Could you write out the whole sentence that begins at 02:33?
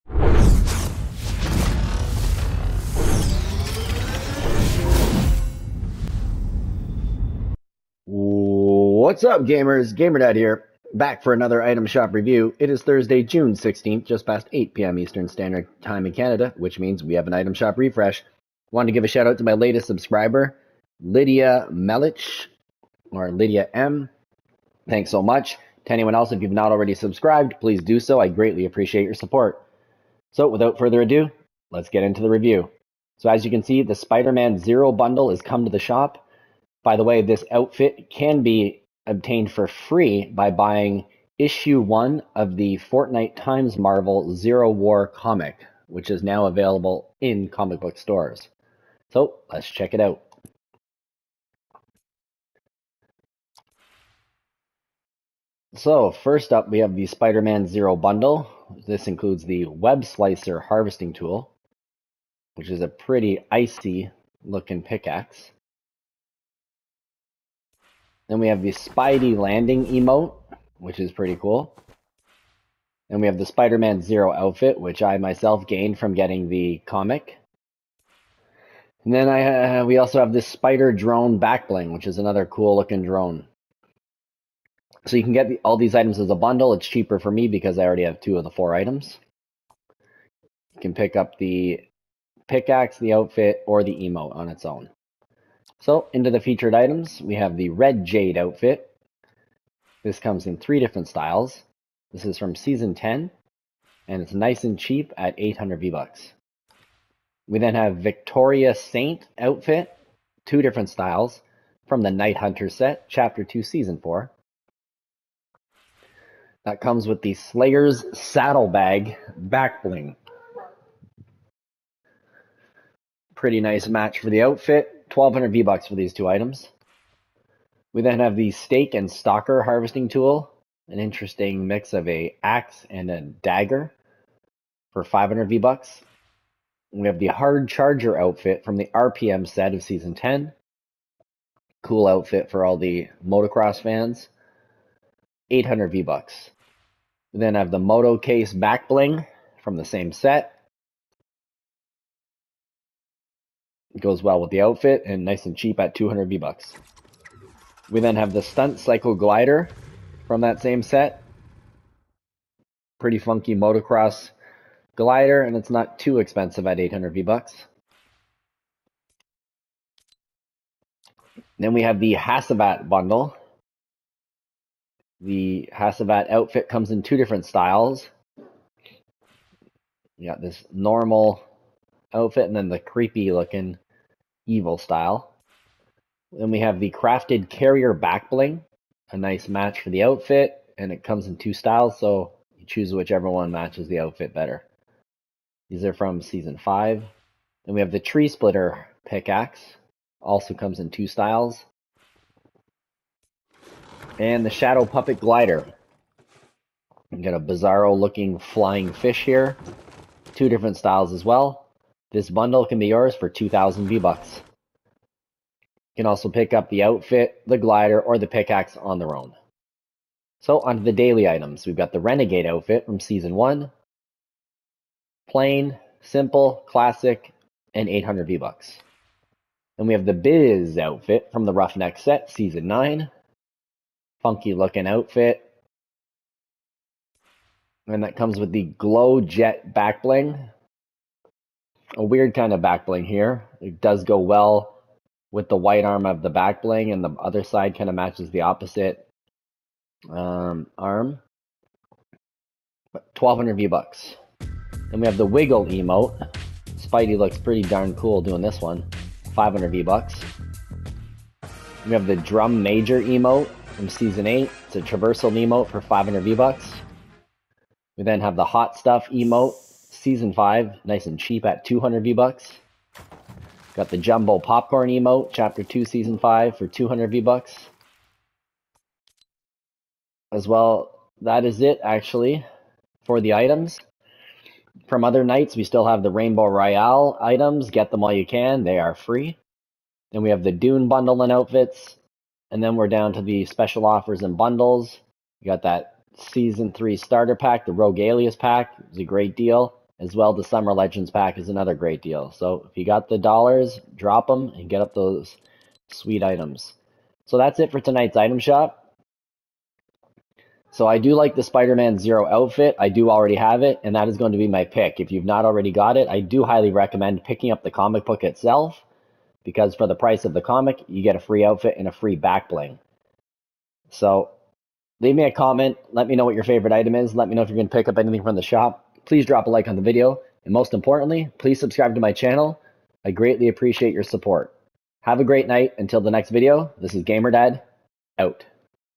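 goes well with the outfit and nice and cheap at 200 V-Bucks.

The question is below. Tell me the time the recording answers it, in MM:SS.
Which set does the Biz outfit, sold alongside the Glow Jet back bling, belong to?
03:51.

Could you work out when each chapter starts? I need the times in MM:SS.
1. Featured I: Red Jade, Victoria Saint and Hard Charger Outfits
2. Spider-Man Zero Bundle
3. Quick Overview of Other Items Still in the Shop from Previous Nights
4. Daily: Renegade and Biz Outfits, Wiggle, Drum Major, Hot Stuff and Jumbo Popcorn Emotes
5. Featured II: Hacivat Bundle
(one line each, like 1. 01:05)
1. 01:34
2. 00:52
3. 04:39
4. 03:39
5. 02:50.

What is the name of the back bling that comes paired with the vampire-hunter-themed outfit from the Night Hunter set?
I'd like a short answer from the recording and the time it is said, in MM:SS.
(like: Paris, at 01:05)
Slayer's Saddlebag, at 01:57.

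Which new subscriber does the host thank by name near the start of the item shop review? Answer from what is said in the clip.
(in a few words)
Lydia Melich.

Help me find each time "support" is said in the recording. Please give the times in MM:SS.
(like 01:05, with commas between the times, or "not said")
00:29, 05:34.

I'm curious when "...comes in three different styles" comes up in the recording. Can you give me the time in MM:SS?
01:40.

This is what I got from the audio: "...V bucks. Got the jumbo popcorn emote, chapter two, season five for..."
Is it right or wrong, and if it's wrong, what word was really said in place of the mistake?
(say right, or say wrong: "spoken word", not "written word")
right.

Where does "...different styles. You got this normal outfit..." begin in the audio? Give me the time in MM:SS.
02:57.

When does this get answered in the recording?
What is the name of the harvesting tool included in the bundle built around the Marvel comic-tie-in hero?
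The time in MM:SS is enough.
00:59.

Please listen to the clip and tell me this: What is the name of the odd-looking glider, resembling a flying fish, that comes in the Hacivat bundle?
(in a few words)
Shadow Puppet.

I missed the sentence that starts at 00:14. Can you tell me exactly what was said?
Eastern Standard Time in Canada, which means we have an item shop refresh.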